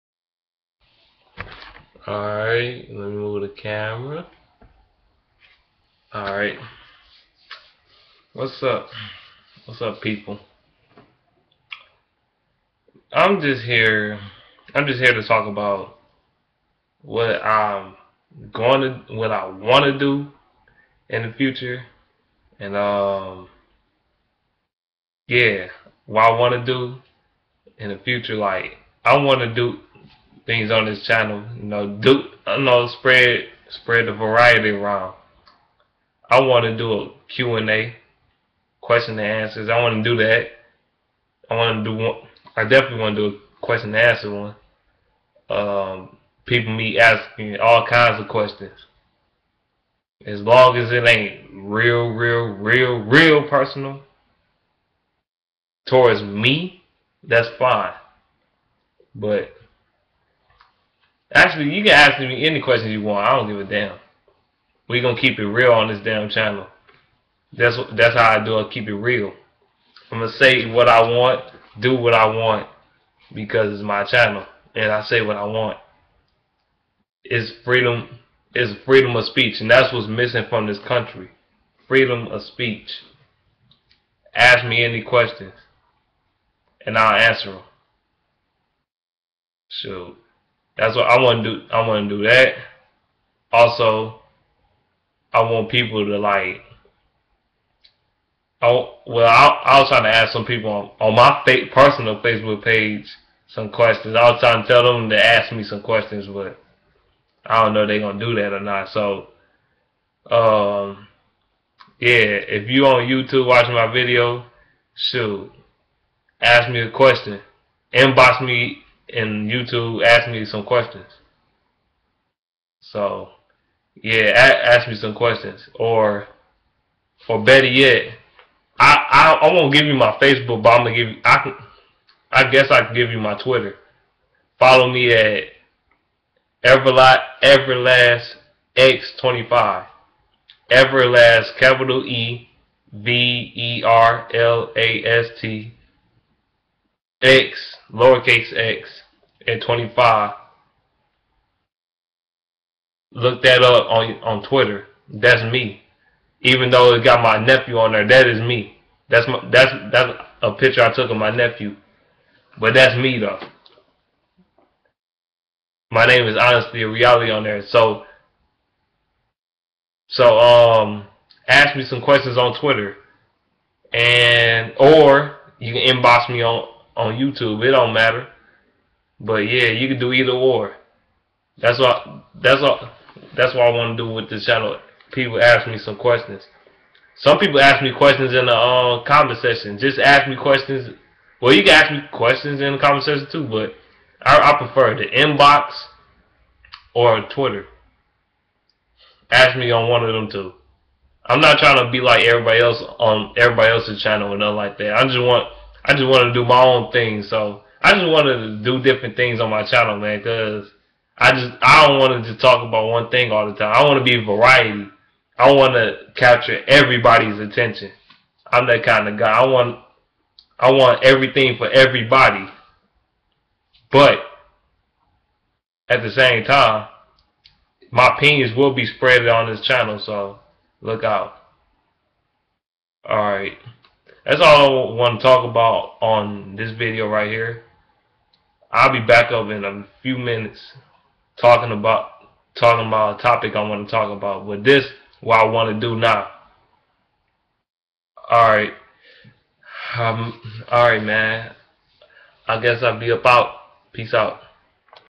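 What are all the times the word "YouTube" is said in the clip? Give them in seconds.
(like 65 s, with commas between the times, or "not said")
113 s, 119 s, 177 s.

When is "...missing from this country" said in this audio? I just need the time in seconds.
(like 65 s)
80 s.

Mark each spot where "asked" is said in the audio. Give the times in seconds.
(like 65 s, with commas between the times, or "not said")
120 s.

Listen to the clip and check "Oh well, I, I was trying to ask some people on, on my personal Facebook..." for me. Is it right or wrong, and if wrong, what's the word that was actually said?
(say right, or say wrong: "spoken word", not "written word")
right.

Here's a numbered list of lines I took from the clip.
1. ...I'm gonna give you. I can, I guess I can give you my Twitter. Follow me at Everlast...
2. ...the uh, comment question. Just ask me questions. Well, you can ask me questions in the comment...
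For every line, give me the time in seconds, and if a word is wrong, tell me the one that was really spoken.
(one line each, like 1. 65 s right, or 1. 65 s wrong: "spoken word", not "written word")
1. 130 s right
2. 188 s wrong: "section", not "question".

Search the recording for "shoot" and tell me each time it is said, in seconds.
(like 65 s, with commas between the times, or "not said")
89 s, 114 s.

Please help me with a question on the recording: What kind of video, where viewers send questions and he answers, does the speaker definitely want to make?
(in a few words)
Q and A.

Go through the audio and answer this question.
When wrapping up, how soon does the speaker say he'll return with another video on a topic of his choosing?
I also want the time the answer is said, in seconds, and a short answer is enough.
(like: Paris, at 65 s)
In a few minutes, at 239 s.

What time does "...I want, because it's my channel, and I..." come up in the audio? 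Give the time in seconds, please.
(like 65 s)
72 s.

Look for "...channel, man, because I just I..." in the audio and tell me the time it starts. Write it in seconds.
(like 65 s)
209 s.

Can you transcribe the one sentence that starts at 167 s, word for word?
So so um ask me some questions on Twitter.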